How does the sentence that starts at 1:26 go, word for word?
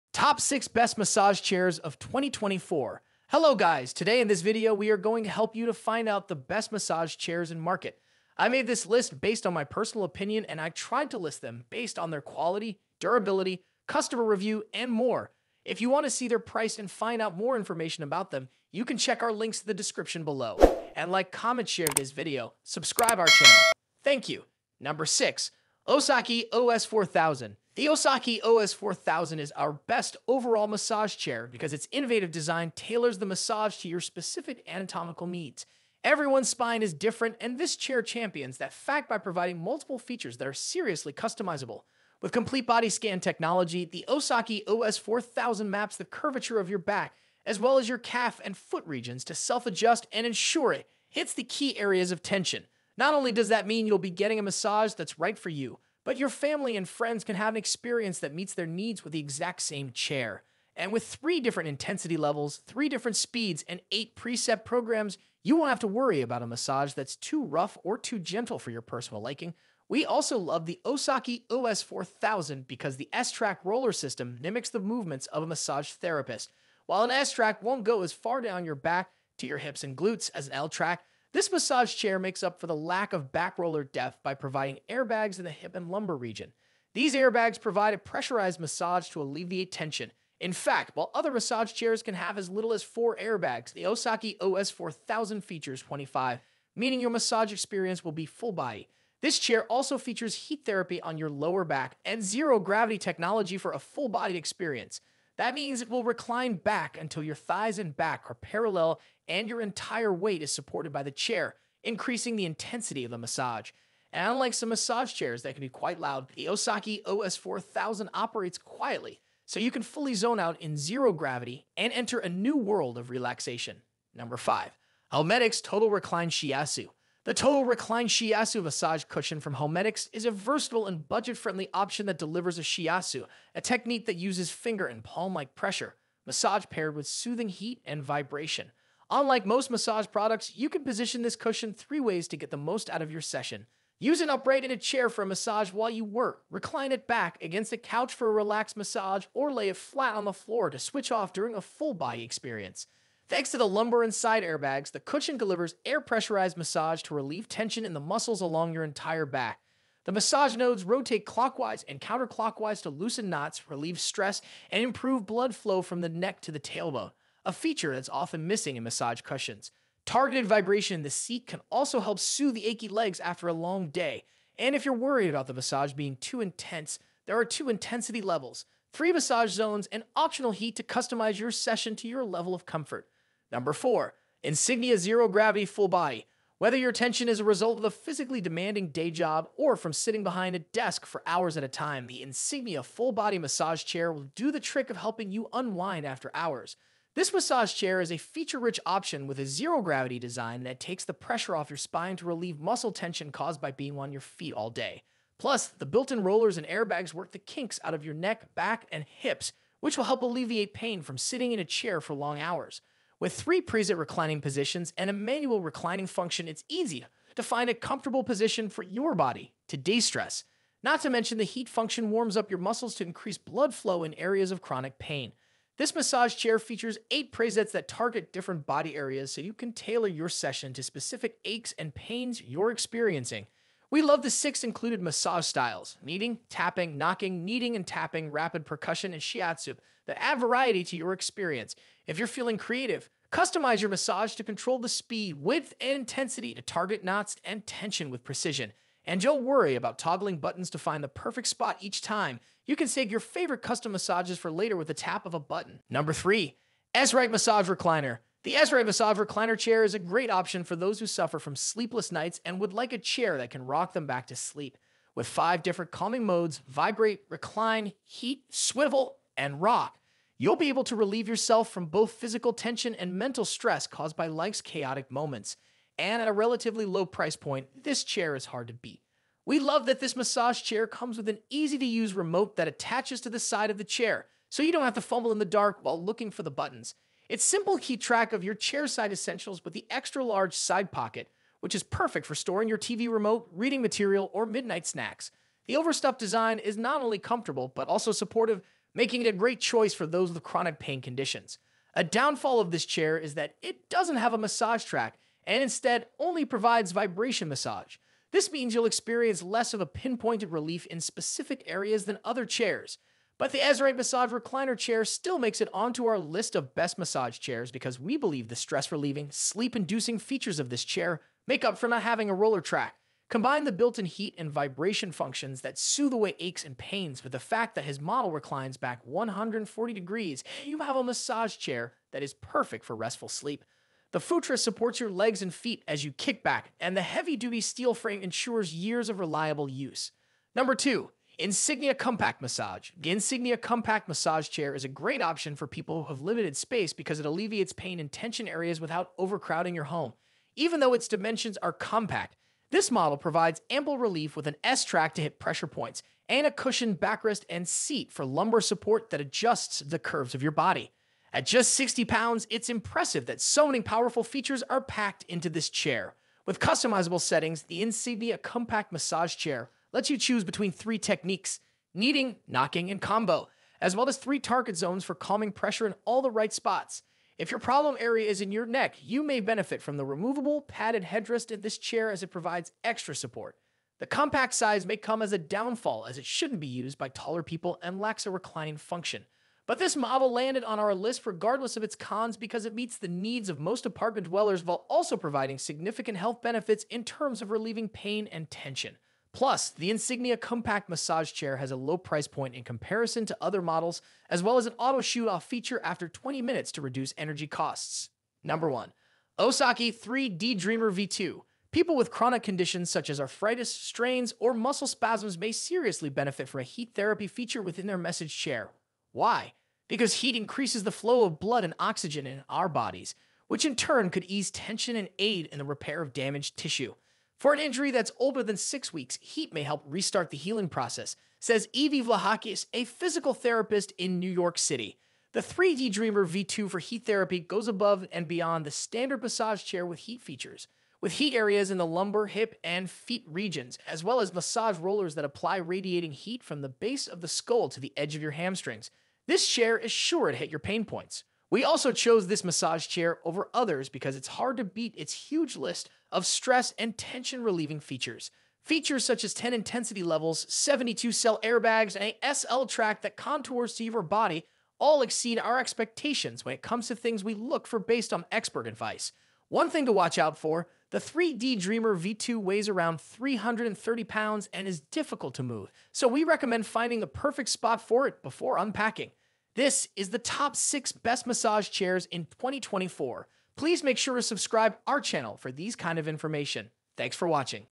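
These airbags provide a pressurized massage to alleviate tension.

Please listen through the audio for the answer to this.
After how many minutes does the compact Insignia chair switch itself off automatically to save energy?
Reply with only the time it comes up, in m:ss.
6:46.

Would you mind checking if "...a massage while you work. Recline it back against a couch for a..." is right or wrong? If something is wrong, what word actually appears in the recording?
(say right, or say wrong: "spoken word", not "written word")
right.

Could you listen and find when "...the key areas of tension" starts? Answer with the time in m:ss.
0:51.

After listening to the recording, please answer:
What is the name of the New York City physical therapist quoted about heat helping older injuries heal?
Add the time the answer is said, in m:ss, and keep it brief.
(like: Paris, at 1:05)
Evie Vlahakis, at 7:11.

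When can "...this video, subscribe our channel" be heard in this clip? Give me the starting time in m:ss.
0:21.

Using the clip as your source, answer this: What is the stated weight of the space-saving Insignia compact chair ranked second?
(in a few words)
60 pounds.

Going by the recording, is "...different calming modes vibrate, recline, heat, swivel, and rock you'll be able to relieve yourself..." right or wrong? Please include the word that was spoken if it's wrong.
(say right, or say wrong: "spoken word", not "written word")
right.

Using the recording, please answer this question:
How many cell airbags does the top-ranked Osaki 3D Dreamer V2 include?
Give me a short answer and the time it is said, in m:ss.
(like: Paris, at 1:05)
72, at 7:40.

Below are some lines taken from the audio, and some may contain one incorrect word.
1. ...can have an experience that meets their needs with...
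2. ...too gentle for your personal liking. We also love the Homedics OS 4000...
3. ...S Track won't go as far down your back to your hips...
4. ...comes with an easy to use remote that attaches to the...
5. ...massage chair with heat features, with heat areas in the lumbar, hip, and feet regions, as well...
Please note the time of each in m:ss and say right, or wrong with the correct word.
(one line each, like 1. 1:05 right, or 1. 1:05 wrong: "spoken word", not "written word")
1. 0:57 right
2. 1:07 wrong: "Osaki", not "Homedics"
3. 1:17 right
4. 4:40 right
5. 7:19 right.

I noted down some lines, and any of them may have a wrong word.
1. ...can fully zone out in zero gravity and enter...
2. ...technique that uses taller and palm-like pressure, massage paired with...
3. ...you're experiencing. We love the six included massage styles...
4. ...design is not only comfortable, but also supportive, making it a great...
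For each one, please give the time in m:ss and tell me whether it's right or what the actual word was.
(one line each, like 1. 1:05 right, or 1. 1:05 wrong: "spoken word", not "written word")
1. 1:59 right
2. 2:13 wrong: "finger", not "taller"
3. 3:52 right
4. 4:56 right.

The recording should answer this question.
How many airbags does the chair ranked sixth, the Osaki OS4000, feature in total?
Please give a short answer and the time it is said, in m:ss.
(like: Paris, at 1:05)
25, at 1:35.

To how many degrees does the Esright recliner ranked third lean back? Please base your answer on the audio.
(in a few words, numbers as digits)
140 degrees.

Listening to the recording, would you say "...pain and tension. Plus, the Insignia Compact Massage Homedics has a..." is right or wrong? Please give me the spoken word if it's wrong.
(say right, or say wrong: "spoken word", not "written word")
wrong: "Chair", not "Homedics".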